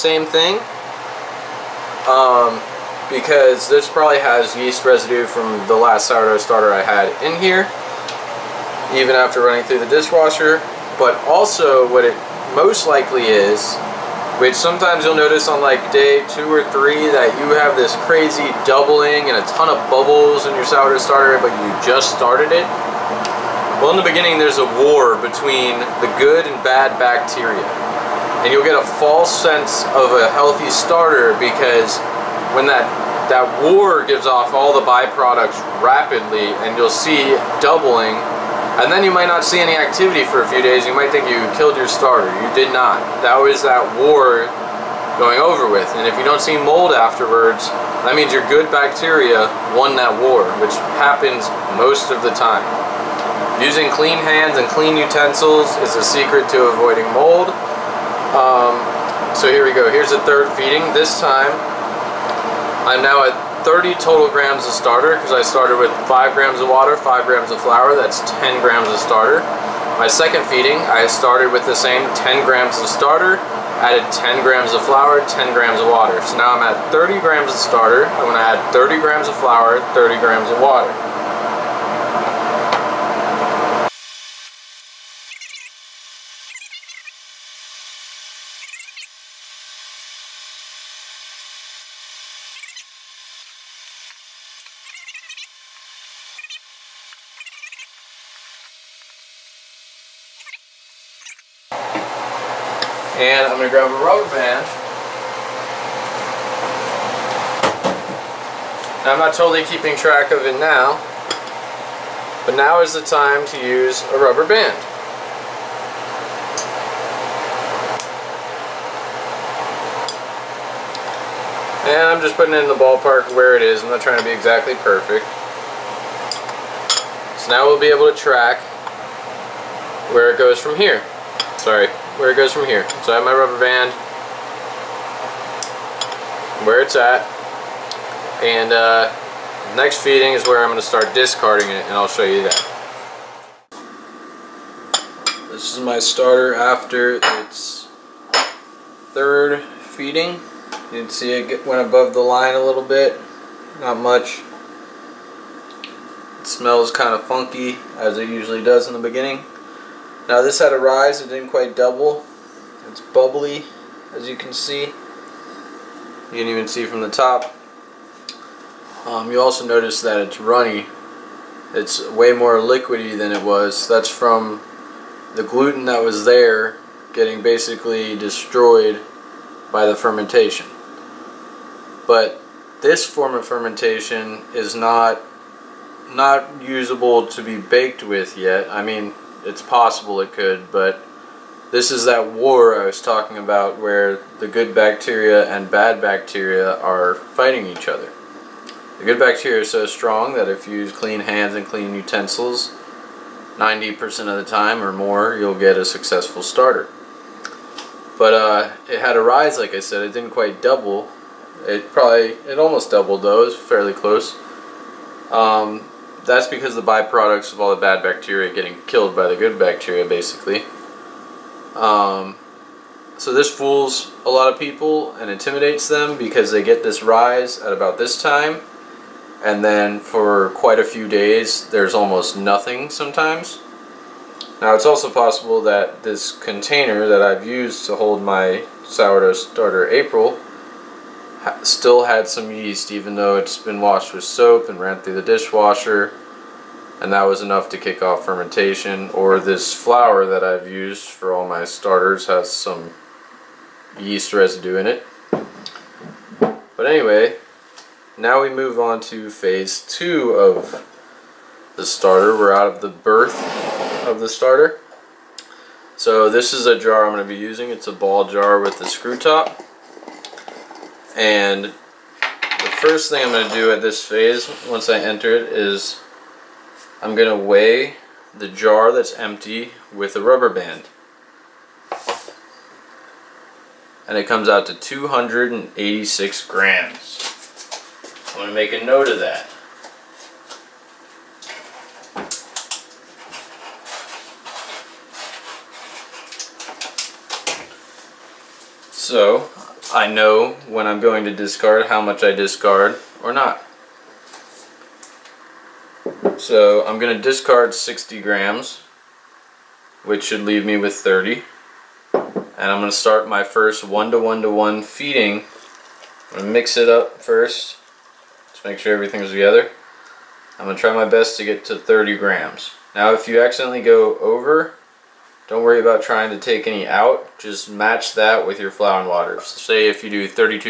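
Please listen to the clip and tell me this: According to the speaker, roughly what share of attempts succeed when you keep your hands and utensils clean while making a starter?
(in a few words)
90% or more.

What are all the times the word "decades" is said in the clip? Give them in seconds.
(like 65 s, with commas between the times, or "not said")
not said.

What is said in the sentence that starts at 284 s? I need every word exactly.
And it comes out to 286 grams.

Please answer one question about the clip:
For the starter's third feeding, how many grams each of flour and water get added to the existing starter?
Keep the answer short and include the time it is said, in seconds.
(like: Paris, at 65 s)
30 grams, at 78 s.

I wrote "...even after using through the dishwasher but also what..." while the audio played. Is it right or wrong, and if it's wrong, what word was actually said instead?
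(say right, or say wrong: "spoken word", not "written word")
wrong: "running", not "using".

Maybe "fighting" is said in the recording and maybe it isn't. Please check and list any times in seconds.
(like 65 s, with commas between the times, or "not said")
197 s.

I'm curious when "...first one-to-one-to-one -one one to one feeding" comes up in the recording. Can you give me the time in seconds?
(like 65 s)
313 s.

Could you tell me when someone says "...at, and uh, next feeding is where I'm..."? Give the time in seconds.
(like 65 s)
136 s.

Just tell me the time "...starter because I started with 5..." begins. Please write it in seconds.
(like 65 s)
64 s.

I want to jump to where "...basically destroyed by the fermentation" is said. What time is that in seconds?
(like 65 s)
177 s.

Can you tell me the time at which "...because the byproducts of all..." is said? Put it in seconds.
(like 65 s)
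216 s.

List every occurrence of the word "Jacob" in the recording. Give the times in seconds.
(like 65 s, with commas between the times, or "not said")
not said.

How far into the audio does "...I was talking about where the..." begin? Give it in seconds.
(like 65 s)
192 s.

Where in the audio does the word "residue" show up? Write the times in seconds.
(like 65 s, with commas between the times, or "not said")
4 s, 254 s.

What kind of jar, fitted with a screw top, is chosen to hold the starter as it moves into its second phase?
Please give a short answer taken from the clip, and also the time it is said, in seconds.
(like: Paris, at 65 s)
ball jar, at 267 s.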